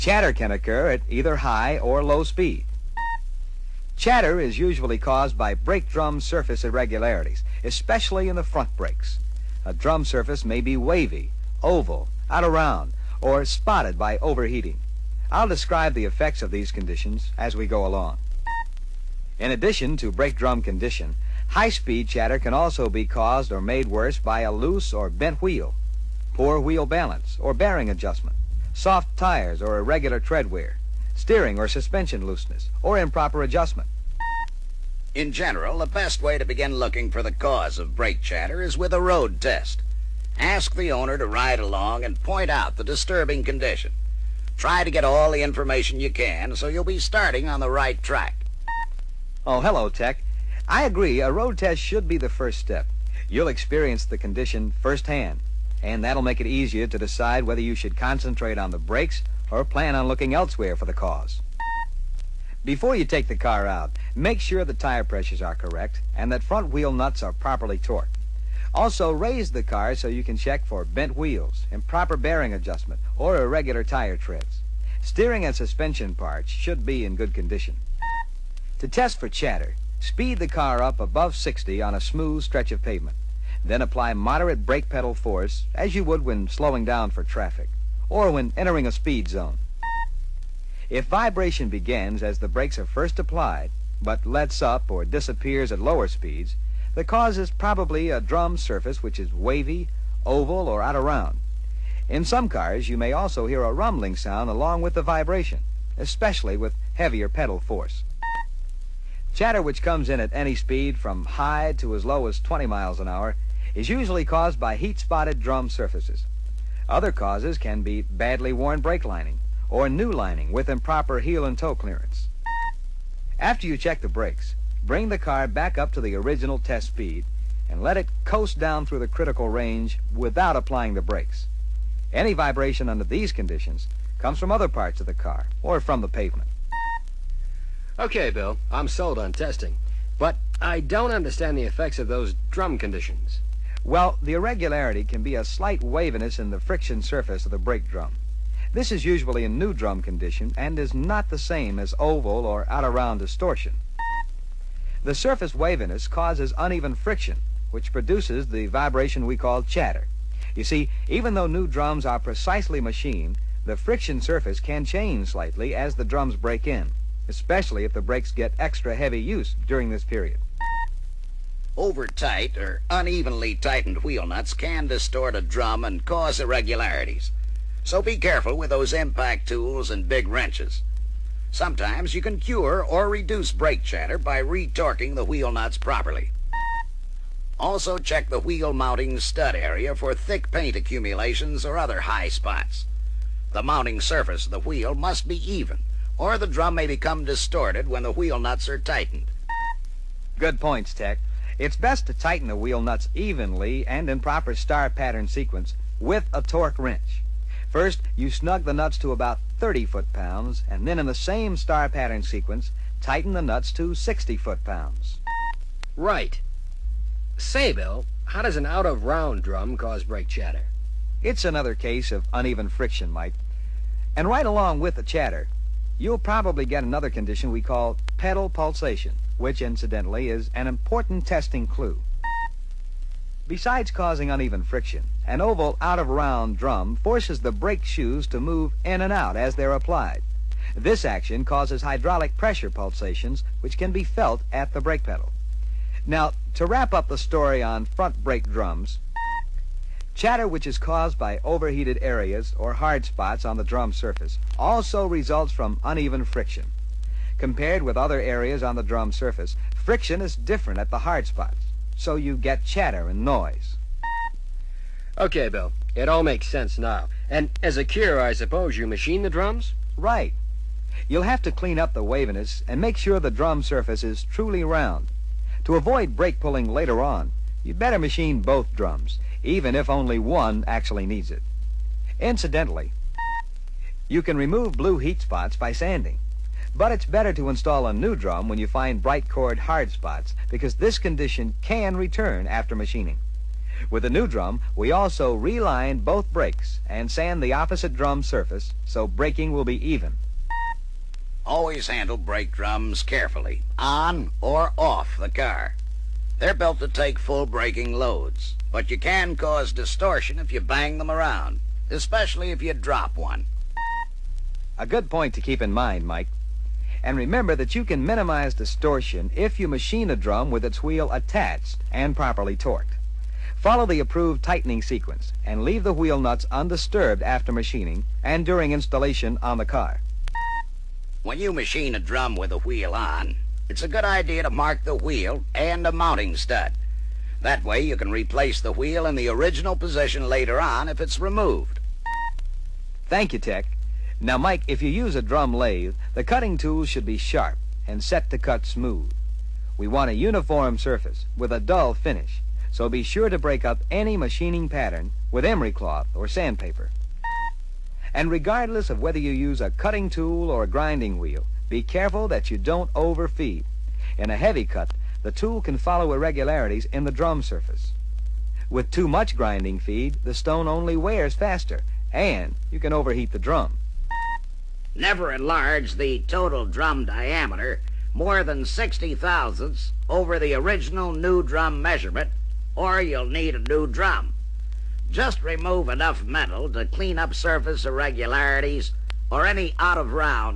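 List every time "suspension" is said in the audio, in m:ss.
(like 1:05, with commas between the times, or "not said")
0:31, 1:15.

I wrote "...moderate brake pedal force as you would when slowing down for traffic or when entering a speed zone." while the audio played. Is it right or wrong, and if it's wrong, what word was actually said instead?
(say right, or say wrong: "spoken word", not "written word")
right.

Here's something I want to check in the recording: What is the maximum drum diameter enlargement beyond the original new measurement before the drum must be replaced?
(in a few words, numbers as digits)
60 thousandths.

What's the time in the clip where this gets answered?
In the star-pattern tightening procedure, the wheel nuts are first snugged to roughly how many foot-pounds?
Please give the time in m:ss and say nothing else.
3:29.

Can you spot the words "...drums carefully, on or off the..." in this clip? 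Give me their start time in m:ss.
5:02.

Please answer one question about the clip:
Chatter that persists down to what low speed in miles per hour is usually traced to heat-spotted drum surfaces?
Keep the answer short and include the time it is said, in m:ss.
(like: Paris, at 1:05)
20, at 1:52.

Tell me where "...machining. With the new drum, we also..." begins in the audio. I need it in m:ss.
4:52.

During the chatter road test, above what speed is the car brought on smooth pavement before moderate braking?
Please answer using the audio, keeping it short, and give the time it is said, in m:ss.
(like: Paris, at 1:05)
60, at 1:21.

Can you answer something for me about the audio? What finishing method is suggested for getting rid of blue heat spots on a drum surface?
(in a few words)
sanding.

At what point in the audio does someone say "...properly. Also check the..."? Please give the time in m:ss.
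3:05.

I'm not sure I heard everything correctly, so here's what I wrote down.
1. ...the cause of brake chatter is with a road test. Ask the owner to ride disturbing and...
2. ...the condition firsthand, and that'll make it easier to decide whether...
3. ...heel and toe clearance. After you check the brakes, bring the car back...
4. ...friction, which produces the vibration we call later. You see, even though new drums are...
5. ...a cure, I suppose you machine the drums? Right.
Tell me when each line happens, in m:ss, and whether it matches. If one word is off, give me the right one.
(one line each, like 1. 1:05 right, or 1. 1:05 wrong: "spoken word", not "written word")
1. 0:37 wrong: "along", not "disturbing"
2. 0:54 right
3. 2:01 right
4. 2:36 wrong: "chatter", not "later"
5. 4:27 right.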